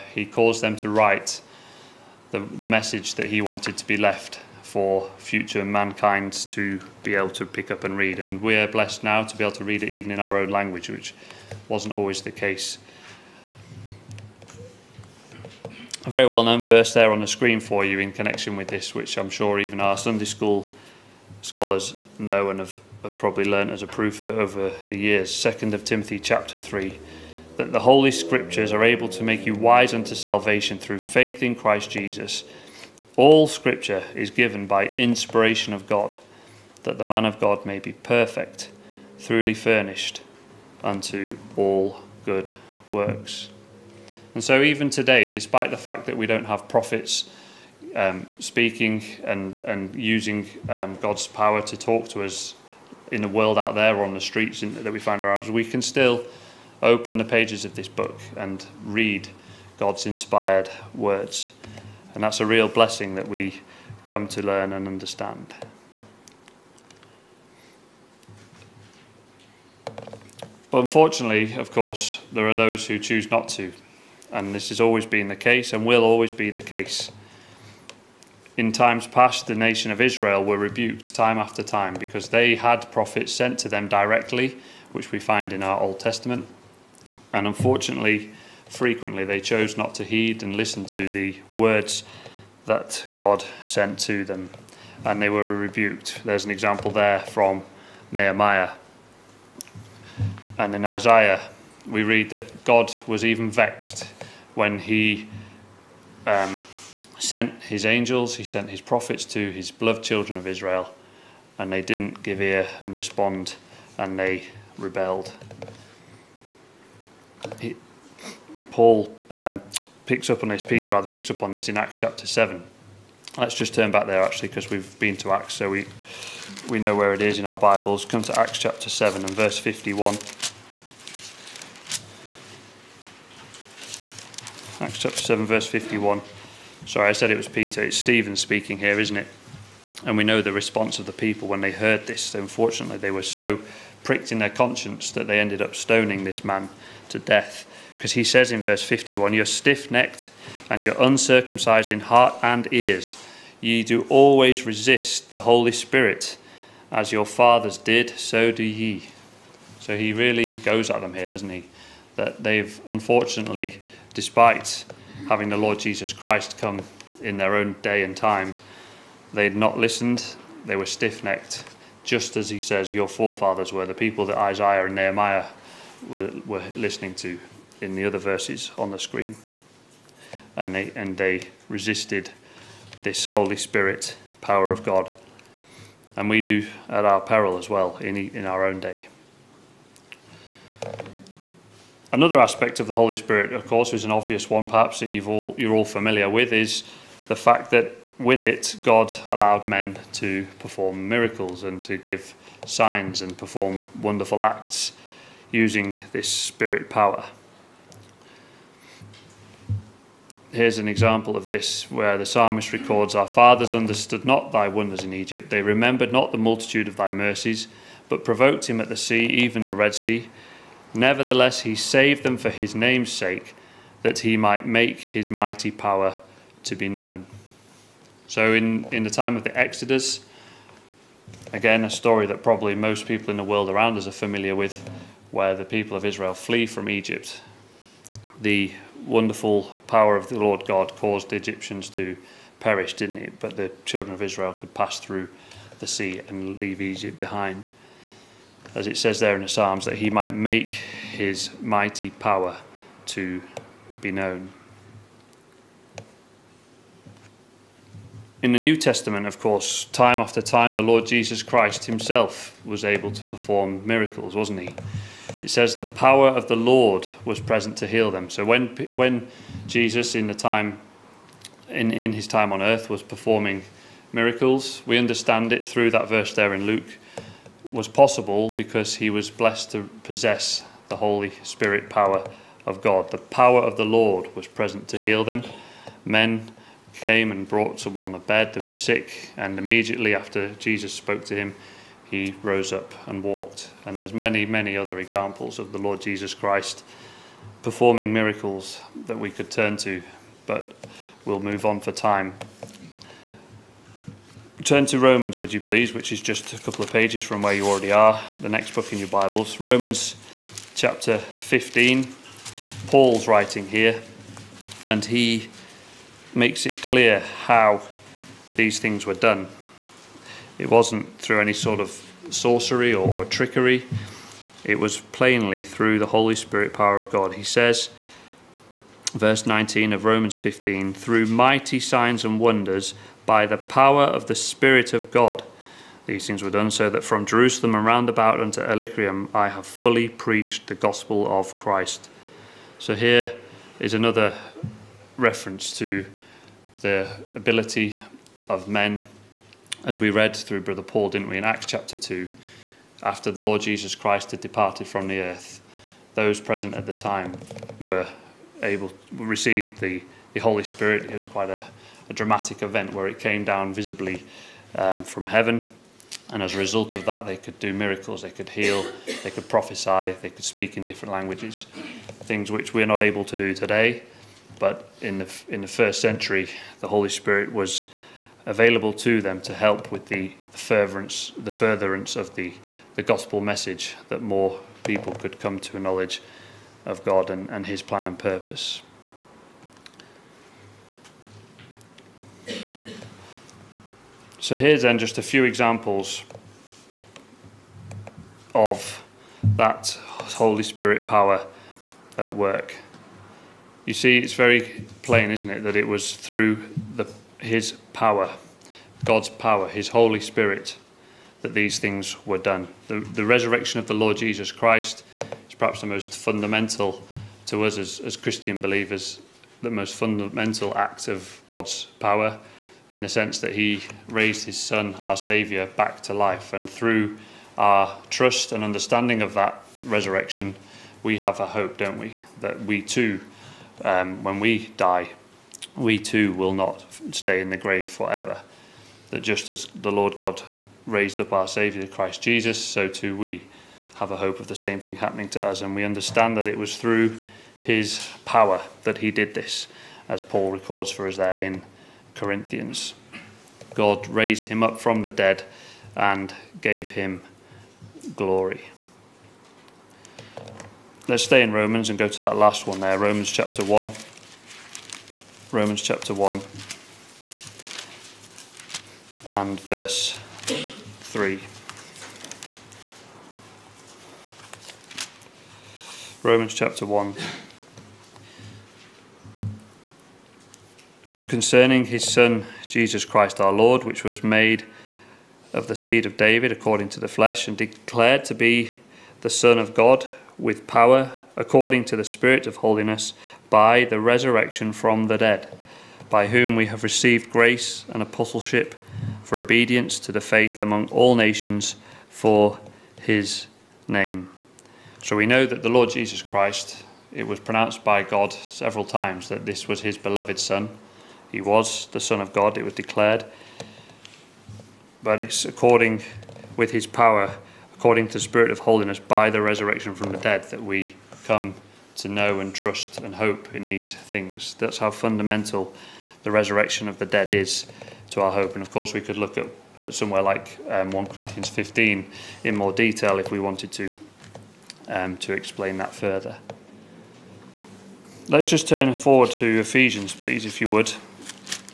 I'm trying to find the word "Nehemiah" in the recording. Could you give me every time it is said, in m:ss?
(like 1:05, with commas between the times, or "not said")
1:38, 2:54.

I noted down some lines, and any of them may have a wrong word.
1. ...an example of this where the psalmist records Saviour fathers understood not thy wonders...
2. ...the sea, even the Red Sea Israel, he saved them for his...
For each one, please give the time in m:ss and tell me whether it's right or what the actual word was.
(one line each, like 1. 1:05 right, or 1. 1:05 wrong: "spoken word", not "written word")
1. 3:30 wrong: "Our", not "Saviour"
2. 3:38 wrong: "Nevertheless", not "Israel".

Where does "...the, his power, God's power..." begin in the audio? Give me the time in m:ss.
6:46.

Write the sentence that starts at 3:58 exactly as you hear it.
The wonderful power of the Lord God caused the Egyptians to perish, didn't it?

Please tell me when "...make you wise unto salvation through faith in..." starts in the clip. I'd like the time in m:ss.
0:29.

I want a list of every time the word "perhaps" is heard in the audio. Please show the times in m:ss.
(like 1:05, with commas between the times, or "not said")
3:14, 6:55.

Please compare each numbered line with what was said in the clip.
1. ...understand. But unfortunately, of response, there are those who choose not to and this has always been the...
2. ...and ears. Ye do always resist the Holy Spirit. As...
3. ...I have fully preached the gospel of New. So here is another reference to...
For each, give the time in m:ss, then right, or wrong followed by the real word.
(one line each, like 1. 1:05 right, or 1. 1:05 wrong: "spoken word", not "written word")
1. 1:04 wrong: "course", not "response"
2. 2:32 right
3. 5:39 wrong: "Christ", not "New".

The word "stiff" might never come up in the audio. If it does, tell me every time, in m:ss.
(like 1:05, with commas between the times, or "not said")
2:29, 2:50.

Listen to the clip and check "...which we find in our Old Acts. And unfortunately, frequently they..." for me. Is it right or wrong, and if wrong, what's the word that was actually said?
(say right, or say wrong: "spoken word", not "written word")
wrong: "Testament", not "Acts".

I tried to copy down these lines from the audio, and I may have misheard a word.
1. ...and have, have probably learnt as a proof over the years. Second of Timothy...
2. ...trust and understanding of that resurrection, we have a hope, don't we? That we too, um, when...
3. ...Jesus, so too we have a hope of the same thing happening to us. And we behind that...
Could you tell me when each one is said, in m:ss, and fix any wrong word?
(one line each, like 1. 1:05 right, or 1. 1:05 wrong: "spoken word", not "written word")
1. 0:22 right
2. 7:08 right
3. 7:22 wrong: "understand", not "behind".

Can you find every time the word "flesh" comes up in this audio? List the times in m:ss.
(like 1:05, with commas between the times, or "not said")
8:07.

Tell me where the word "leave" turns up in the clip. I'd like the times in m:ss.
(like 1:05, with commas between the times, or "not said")
4:06.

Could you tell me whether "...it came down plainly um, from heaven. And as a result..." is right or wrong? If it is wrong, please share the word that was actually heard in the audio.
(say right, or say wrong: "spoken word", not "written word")
wrong: "visibly", not "plainly".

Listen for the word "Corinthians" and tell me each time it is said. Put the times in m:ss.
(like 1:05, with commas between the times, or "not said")
7:32, 8:51.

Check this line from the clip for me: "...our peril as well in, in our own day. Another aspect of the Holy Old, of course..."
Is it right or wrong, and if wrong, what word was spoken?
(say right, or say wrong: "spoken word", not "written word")
wrong: "Spirit", not "Old".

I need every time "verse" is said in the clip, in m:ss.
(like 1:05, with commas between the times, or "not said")
0:16, 2:09, 2:15, 2:28, 2:58, 4:36, 5:29, 7:49.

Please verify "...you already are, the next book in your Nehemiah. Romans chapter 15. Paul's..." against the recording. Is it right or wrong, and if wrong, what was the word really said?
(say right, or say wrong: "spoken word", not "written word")
wrong: "Bibles", not "Nehemiah".